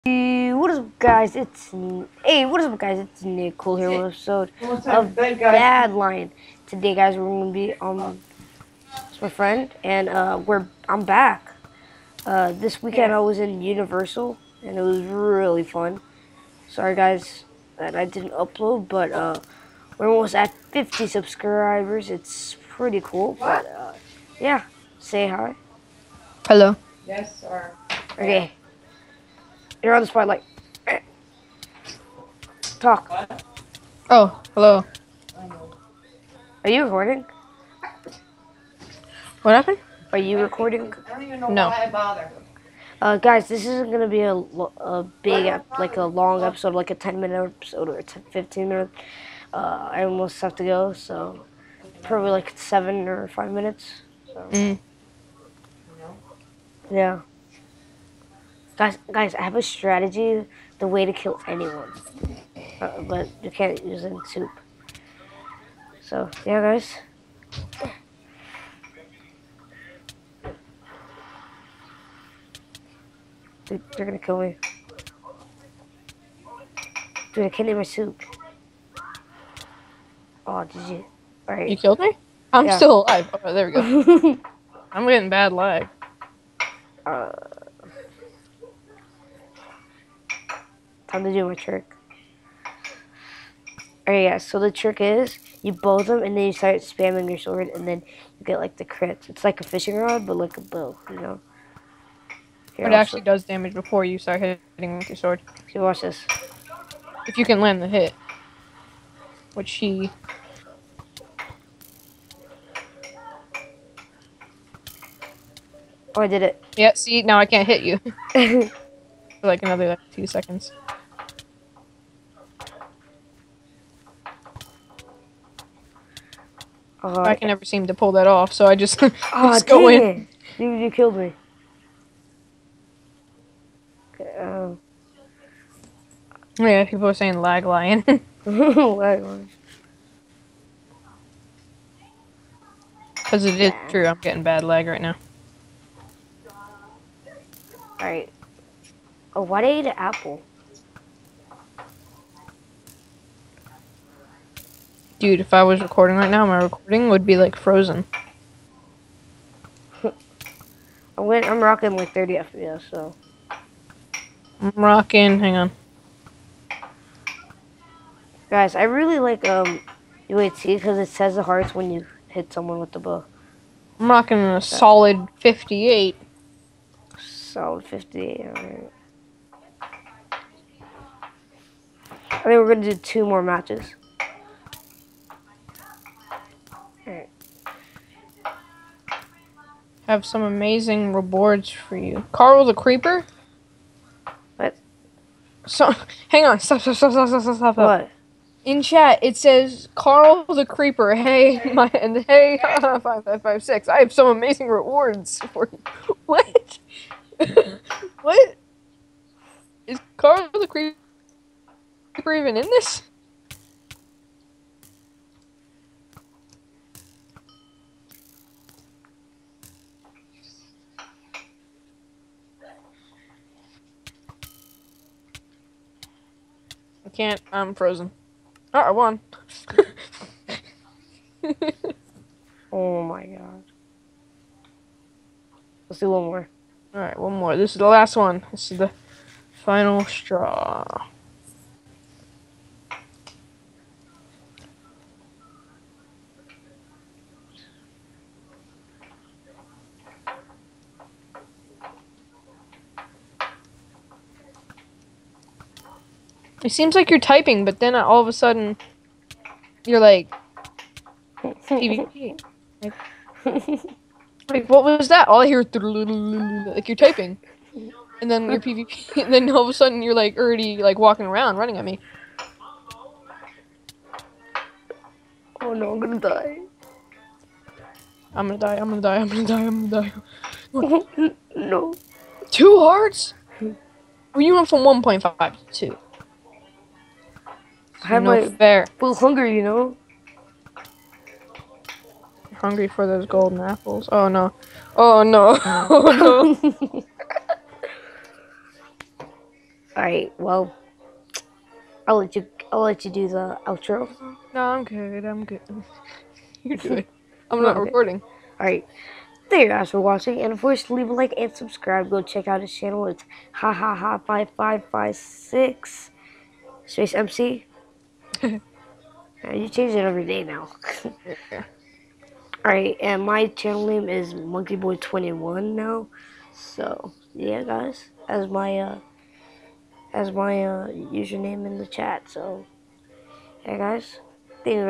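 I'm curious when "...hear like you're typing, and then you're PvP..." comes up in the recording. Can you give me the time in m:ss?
4:25.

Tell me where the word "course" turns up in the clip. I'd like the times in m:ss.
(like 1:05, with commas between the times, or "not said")
5:10.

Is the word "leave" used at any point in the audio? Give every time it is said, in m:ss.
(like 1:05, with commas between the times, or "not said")
5:10.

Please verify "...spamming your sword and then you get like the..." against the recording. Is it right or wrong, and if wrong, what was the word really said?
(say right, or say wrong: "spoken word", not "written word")
right.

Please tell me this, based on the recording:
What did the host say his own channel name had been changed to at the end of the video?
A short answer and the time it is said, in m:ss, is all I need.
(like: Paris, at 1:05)
MonkeyBoy21, at 5:24.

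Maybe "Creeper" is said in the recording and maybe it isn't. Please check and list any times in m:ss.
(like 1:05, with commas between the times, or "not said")
3:12, 3:20, 3:30.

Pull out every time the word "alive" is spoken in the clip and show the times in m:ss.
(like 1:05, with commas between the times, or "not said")
1:23.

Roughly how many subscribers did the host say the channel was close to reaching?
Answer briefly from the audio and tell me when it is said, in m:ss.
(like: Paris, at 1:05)
50, at 0:20.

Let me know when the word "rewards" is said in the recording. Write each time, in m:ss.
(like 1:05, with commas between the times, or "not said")
3:11, 3:24.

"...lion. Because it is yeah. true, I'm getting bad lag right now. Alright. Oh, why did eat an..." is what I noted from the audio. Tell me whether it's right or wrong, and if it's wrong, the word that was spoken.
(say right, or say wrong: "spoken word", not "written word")
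right.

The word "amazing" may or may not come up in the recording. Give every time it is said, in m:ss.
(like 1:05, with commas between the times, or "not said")
3:10, 3:24.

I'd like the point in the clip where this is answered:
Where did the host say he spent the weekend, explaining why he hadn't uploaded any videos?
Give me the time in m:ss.
0:13.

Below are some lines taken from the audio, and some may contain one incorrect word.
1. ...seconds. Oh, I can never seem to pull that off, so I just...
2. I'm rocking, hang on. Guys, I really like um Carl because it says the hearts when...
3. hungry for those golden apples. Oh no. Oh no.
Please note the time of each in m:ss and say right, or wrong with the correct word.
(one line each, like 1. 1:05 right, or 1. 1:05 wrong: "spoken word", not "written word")
1. 2:00 right
2. 2:44 wrong: "UAT", not "Carl"
3. 4:52 right.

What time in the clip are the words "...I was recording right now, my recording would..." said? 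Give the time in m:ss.
2:35.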